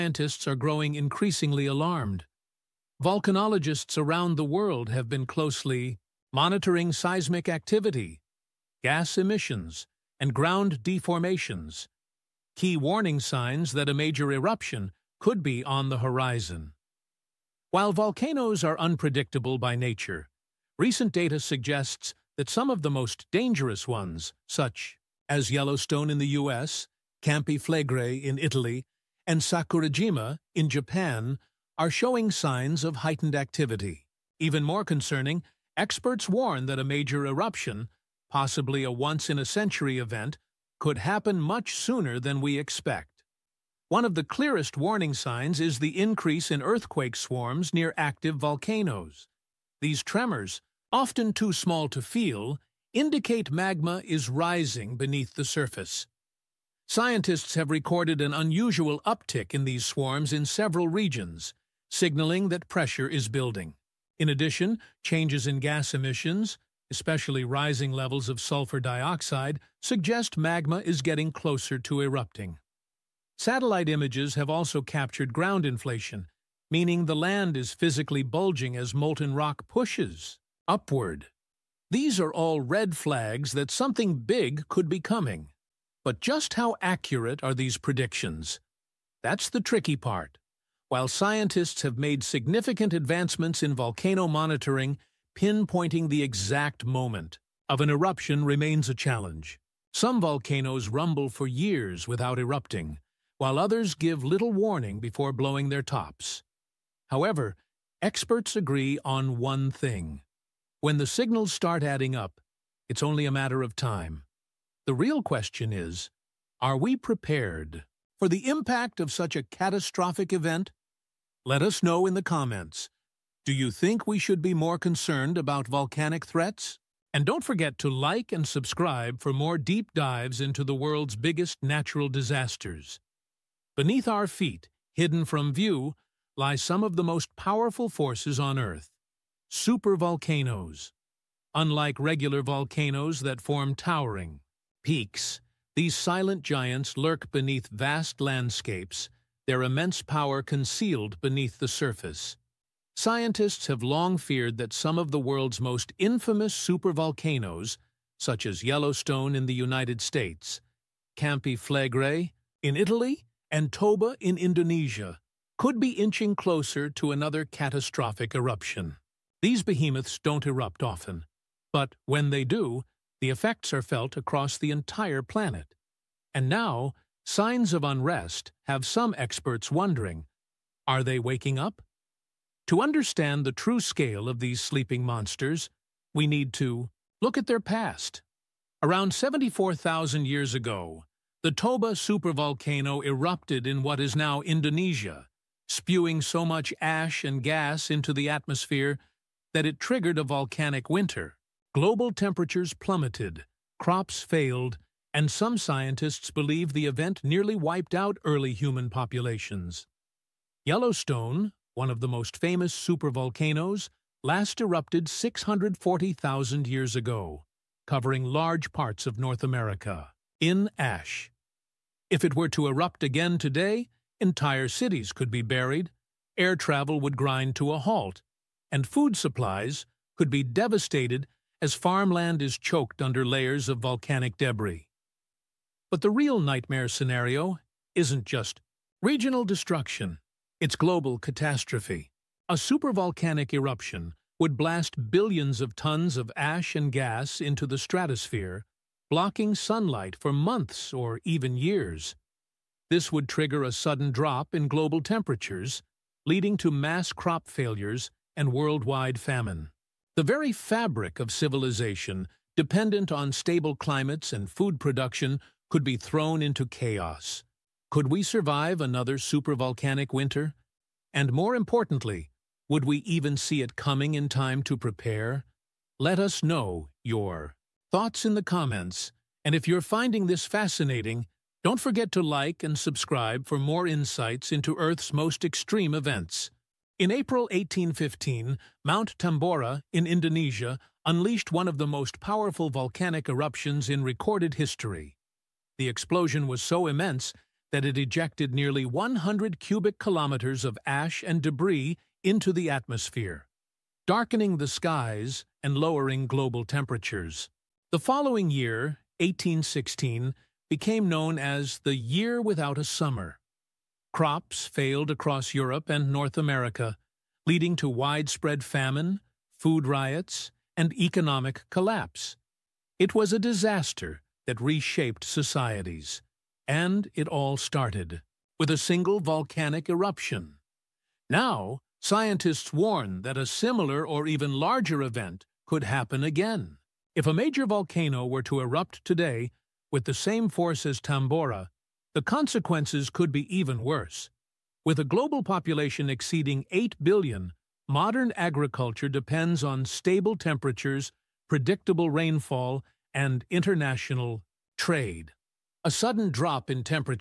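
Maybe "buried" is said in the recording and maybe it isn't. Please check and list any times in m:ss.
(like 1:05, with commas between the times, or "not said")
3:45.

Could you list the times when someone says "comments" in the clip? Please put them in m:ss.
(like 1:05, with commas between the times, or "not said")
2:02, 4:38.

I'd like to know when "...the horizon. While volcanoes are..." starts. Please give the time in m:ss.
0:15.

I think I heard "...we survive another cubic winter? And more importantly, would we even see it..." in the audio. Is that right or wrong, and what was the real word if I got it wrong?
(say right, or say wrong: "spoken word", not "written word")
wrong: "supervolcanic", not "cubic".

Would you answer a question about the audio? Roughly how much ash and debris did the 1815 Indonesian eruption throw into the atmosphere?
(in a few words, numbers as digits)
nearly 100 cubic kilometers.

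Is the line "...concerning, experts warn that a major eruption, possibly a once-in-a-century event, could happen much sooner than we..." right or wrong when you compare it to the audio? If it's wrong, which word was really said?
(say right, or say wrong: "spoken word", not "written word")
right.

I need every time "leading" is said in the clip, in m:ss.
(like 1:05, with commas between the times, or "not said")
4:16, 5:17.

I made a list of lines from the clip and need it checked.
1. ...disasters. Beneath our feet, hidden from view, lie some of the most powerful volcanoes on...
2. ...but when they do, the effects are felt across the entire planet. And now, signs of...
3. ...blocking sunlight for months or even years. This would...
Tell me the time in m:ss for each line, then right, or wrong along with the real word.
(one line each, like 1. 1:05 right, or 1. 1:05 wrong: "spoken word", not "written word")
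1. 2:12 wrong: "forces", not "volcanoes"
2. 2:51 right
3. 4:09 right.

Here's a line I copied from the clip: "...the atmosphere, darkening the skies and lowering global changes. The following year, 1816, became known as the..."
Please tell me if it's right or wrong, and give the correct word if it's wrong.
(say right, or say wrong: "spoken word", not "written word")
wrong: "temperatures", not "changes".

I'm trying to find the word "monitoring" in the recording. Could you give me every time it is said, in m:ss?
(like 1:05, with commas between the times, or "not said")
0:06, 1:34.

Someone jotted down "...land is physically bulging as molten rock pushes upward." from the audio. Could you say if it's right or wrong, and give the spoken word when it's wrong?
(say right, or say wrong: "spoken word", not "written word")
right.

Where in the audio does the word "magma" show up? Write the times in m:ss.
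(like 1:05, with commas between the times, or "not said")
0:53, 1:10.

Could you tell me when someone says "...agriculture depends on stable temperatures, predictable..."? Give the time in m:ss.
5:48.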